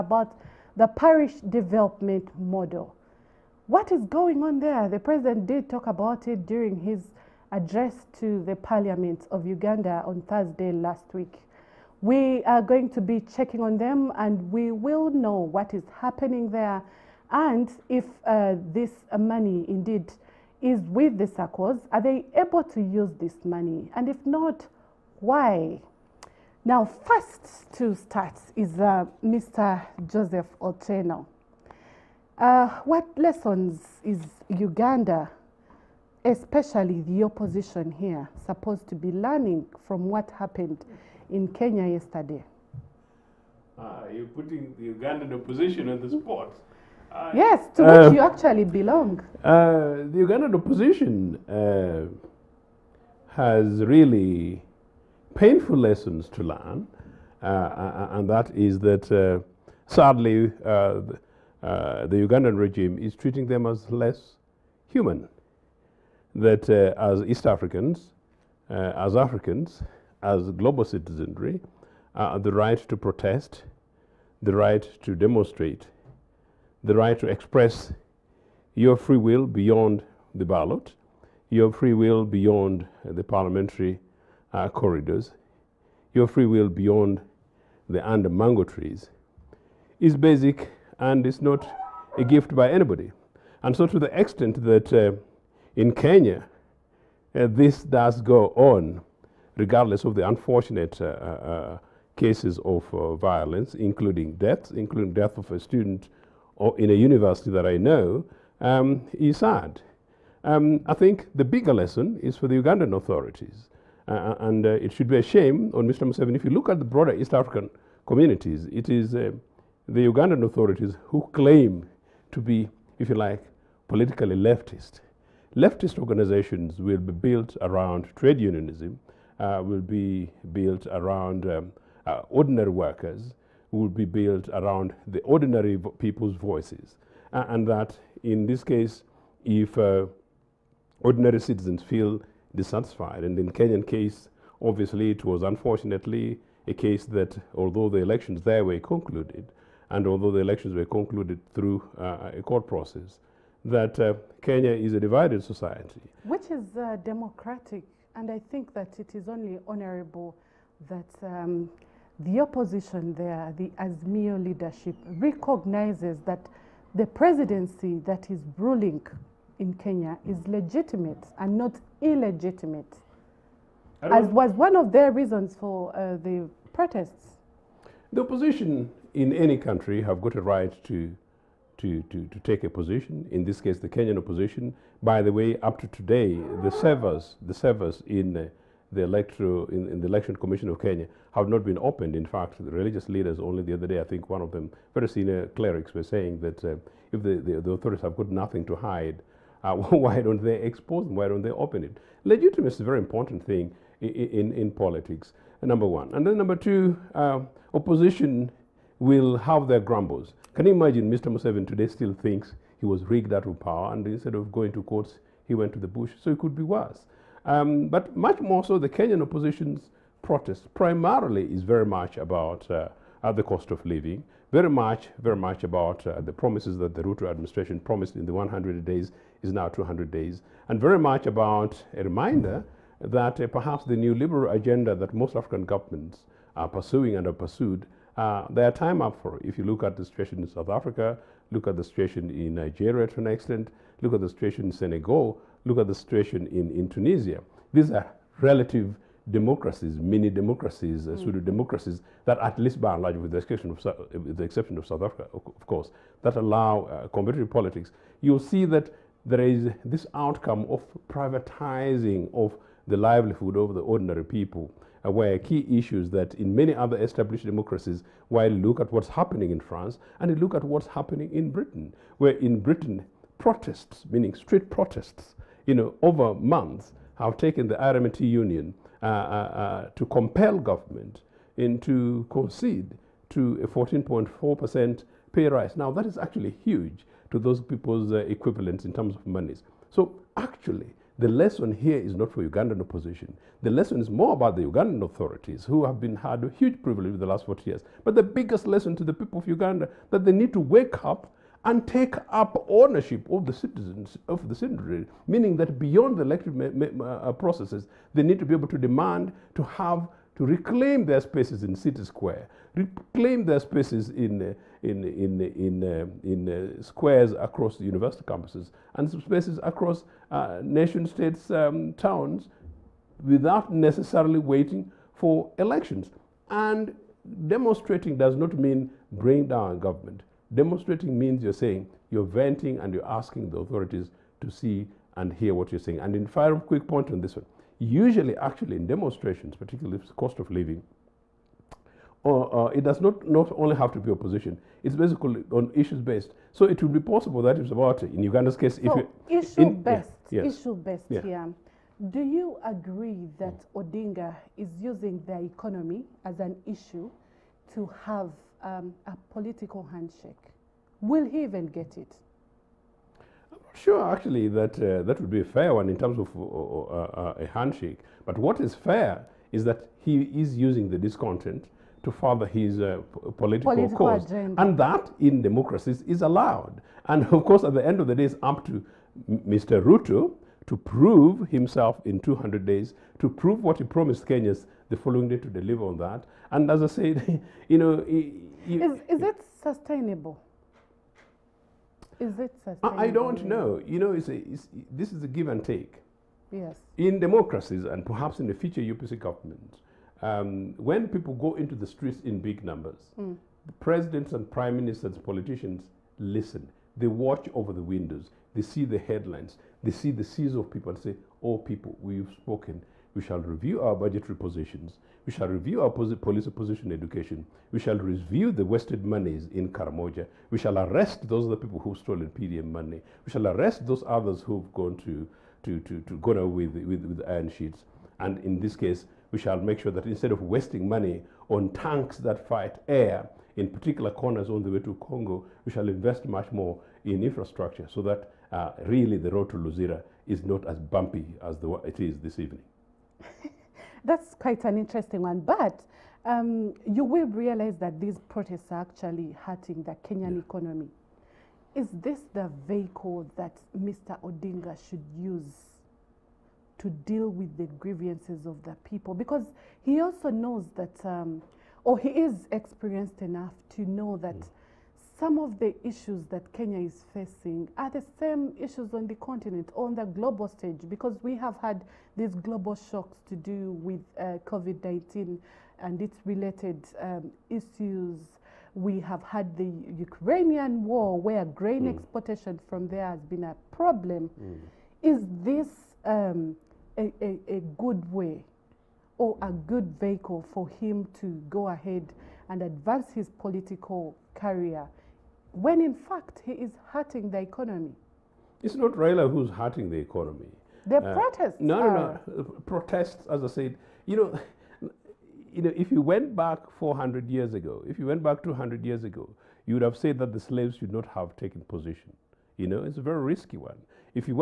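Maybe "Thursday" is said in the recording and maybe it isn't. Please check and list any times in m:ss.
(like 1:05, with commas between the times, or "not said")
0:10.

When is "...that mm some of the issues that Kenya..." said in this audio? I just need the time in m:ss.
7:44.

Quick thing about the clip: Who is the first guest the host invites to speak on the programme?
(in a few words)
Joseph Ochieno.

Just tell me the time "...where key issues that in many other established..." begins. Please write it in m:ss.
4:25.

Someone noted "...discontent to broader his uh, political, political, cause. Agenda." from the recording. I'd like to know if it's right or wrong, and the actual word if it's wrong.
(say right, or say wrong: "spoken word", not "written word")
wrong: "further", not "broader".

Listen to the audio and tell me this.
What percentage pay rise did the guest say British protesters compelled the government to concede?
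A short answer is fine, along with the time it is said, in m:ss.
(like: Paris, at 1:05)
14.4%, at 4:43.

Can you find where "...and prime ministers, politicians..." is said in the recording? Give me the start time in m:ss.
6:44.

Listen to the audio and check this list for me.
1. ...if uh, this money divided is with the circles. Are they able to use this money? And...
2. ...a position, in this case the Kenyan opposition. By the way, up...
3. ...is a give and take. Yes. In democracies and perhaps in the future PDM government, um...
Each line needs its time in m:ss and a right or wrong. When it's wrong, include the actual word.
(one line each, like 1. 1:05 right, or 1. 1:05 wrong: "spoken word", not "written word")
1. 0:17 wrong: "indeed", not "divided"
2. 3:02 right
3. 6:35 wrong: "UPC", not "PDM".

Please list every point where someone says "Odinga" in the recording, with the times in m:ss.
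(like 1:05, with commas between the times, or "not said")
5:53, 7:34.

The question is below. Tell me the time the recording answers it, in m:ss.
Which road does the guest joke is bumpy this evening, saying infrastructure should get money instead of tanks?
7:19.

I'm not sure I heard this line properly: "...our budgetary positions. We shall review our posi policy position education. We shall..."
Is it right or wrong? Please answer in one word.
right.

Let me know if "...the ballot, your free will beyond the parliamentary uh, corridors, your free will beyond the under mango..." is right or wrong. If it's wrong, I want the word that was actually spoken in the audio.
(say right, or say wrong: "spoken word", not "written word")
right.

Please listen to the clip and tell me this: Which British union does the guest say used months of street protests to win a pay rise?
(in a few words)
RMT.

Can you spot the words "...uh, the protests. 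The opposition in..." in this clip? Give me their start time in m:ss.
2:55.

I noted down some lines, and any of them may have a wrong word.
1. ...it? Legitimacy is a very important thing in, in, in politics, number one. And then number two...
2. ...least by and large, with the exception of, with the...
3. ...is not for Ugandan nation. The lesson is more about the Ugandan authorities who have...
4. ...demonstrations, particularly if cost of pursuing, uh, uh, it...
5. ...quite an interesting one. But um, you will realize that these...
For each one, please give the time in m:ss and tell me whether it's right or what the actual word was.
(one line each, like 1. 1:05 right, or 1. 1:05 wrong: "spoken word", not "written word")
1. 3:21 right
2. 4:12 right
3. 4:51 wrong: "opposition", not "nation"
4. 5:38 wrong: "living", not "pursuing"
5. 7:24 right.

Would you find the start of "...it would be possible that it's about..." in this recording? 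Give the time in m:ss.
5:46.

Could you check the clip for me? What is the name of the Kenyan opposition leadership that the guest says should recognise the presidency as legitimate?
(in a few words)
Azmio.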